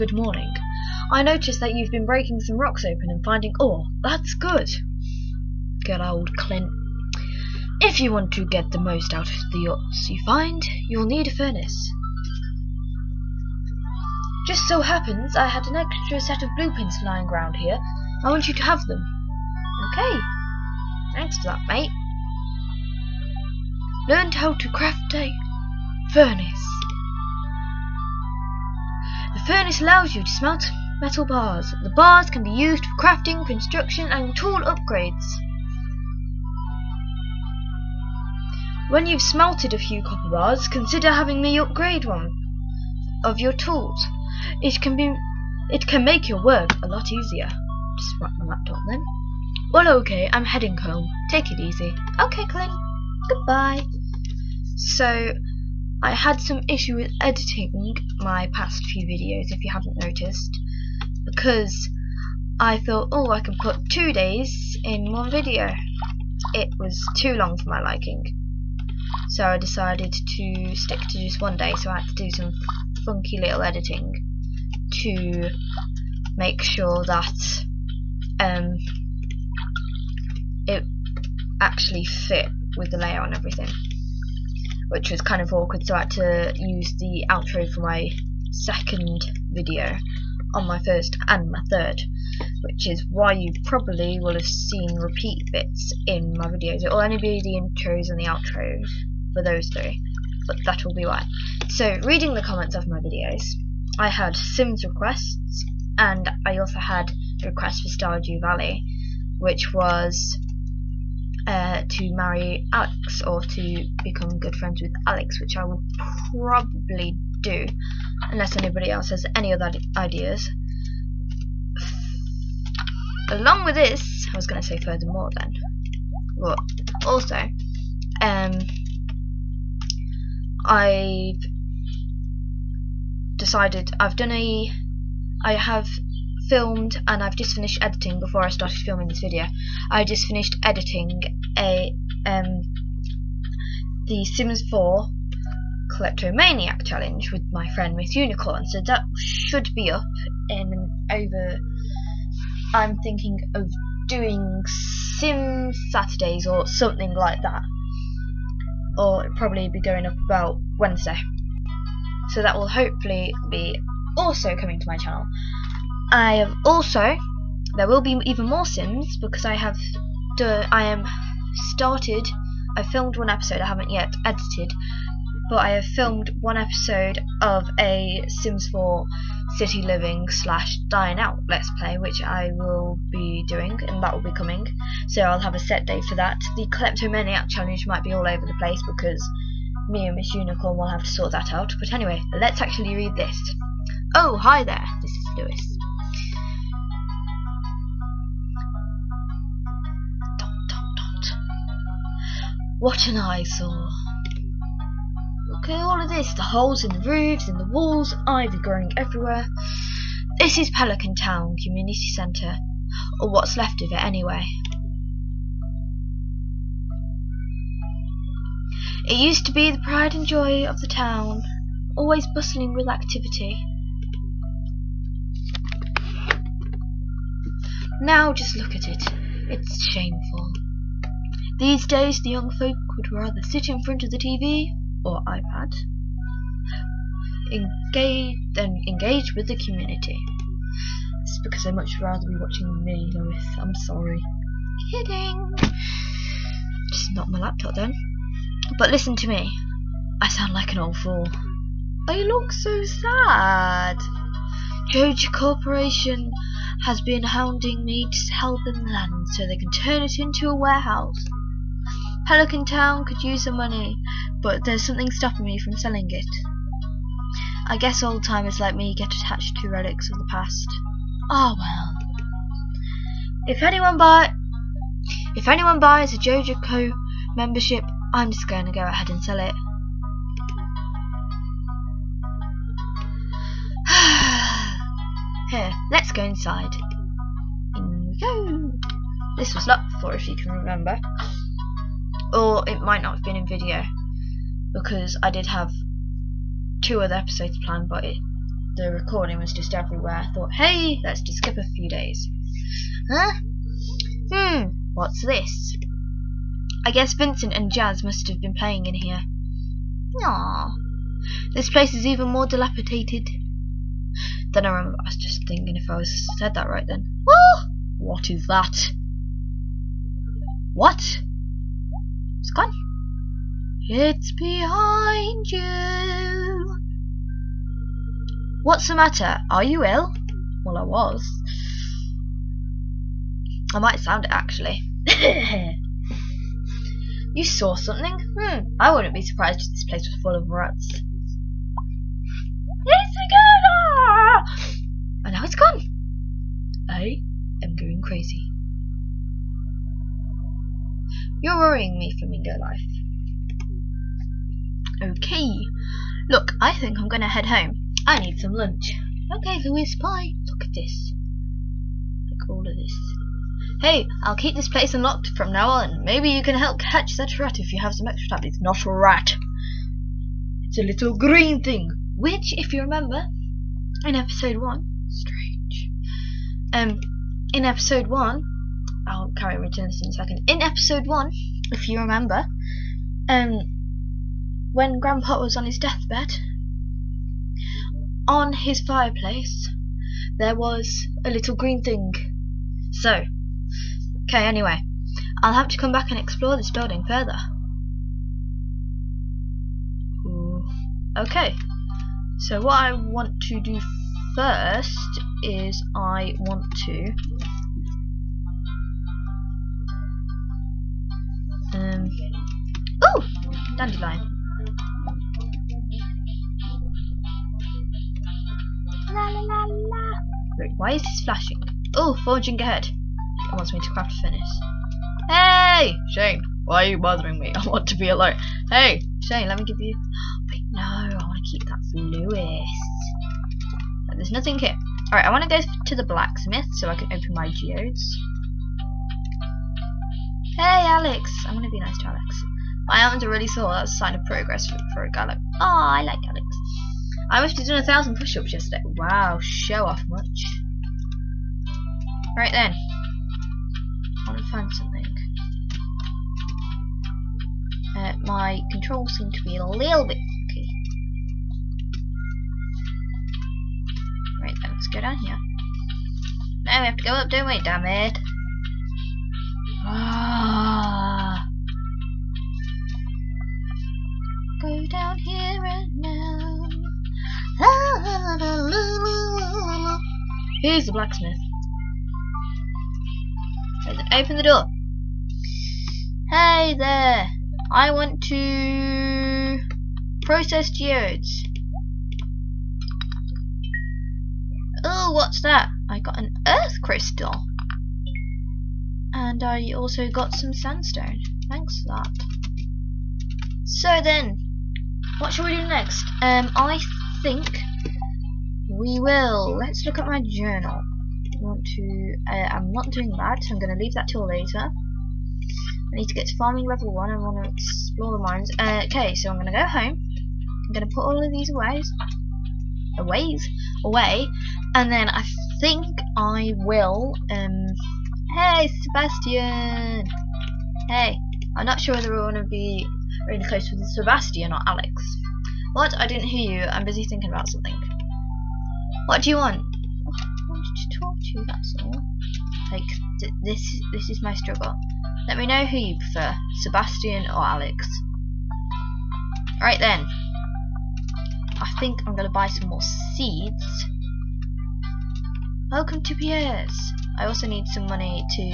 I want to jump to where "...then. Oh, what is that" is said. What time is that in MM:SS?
05:16.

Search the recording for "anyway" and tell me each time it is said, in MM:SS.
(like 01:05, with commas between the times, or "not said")
03:11, 03:34, 06:34.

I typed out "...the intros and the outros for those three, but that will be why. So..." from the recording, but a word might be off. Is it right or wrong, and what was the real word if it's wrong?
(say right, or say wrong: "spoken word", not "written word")
right.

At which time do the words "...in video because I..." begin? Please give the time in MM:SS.
04:53.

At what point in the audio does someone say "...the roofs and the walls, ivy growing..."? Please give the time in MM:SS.
03:26.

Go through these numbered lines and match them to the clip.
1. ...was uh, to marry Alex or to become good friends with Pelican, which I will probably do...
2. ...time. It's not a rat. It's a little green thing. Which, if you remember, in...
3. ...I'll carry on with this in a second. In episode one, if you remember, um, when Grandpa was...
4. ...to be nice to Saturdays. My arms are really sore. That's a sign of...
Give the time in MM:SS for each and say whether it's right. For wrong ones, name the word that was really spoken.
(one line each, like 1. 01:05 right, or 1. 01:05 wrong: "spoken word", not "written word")
1. 01:49 wrong: "Alex", not "Pelican"
2. 06:08 right
3. 06:19 right
4. 07:21 wrong: "Alex", not "Saturdays".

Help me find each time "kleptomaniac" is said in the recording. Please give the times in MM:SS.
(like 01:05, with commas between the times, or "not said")
02:25, 03:06.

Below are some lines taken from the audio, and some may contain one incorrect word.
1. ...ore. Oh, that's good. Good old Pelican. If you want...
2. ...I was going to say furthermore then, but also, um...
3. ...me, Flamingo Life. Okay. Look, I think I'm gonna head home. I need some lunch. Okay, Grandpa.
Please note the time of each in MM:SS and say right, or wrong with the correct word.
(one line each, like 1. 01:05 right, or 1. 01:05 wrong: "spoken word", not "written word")
1. 00:03 wrong: "Clint", not "Pelican"
2. 02:04 right
3. 05:51 wrong: "Lewis", not "Grandpa".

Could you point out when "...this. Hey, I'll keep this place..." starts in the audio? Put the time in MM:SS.
06:02.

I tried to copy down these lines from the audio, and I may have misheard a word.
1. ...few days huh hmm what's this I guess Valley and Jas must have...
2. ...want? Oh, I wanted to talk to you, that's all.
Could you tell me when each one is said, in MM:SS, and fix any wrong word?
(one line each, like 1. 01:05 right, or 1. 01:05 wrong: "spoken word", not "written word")
1. 05:01 wrong: "Vincent", not "Valley"
2. 08:59 right.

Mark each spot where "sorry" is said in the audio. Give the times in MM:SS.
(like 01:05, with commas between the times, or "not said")
04:03.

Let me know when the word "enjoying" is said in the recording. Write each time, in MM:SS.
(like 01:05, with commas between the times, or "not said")
not said.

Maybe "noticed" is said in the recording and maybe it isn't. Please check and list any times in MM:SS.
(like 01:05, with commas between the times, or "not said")
00:01, 00:59.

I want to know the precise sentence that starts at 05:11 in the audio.
This place is even more dilapidated.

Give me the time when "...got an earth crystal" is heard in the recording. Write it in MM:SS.
08:15.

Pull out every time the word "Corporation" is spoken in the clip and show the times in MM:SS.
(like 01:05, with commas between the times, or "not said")
04:15.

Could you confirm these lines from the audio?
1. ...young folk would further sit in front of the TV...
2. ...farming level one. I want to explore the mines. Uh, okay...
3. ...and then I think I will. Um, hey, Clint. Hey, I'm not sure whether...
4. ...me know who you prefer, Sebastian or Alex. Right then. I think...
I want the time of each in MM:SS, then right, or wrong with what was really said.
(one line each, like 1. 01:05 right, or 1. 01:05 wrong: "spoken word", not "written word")
1. 03:52 wrong: "rather", not "further"
2. 08:36 right
3. 08:44 wrong: "Sebastian", not "Clint"
4. 09:05 right.